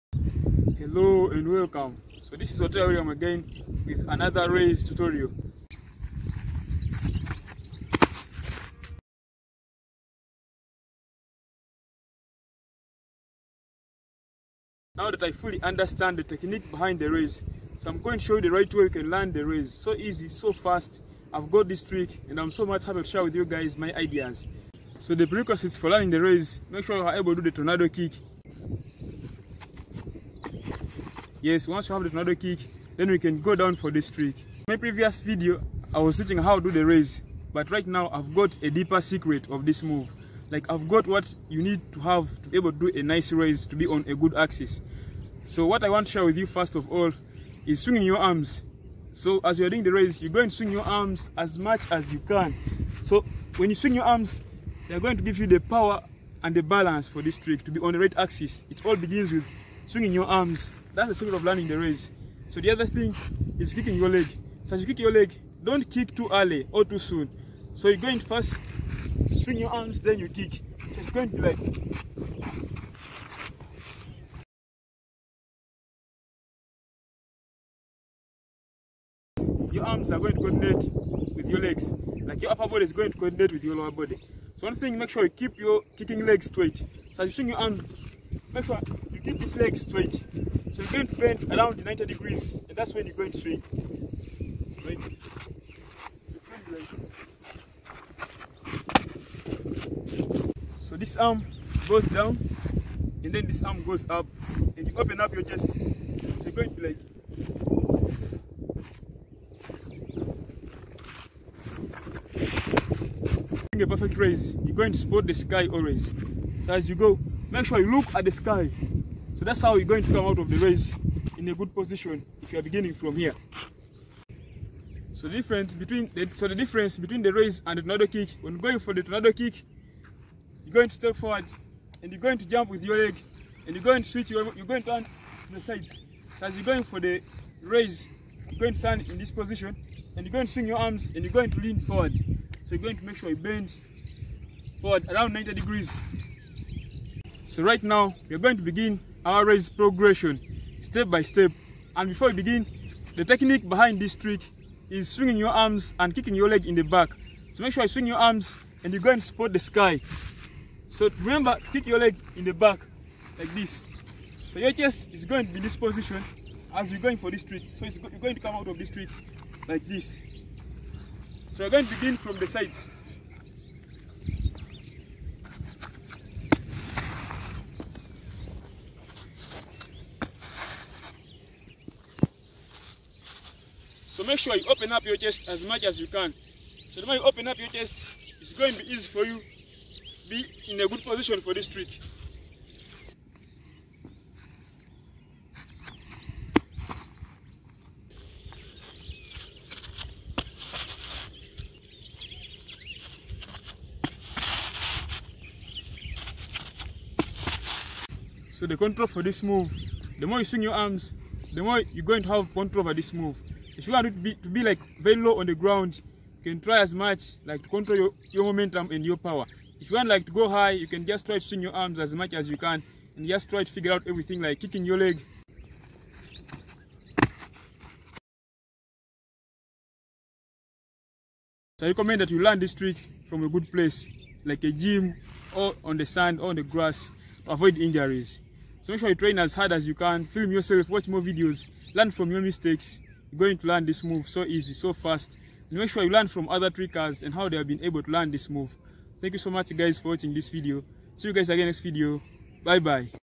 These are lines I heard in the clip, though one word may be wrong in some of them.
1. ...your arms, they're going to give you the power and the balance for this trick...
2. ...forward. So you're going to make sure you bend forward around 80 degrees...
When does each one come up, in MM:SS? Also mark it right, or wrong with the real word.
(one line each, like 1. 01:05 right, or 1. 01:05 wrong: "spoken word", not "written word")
1. 00:53 right
2. 02:21 wrong: "90", not "80".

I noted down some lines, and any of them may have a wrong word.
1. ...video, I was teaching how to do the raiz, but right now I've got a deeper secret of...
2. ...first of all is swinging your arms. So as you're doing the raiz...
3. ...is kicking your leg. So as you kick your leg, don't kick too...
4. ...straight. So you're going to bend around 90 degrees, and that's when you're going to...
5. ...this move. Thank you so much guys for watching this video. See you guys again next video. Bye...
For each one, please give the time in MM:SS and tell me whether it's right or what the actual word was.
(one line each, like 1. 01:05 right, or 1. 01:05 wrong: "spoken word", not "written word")
1. 00:35 right
2. 00:46 right
3. 01:03 right
4. 01:29 right
5. 04:08 right.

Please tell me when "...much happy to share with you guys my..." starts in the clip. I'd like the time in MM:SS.
00:22.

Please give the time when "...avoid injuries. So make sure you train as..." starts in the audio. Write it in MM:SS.
03:57.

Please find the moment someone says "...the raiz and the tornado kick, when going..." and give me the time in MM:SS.
02:07.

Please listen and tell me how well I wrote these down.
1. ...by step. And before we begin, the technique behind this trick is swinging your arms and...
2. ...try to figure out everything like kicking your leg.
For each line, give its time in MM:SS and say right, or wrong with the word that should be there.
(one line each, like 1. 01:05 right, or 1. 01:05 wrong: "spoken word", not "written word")
1. 02:31 right
2. 03:43 right.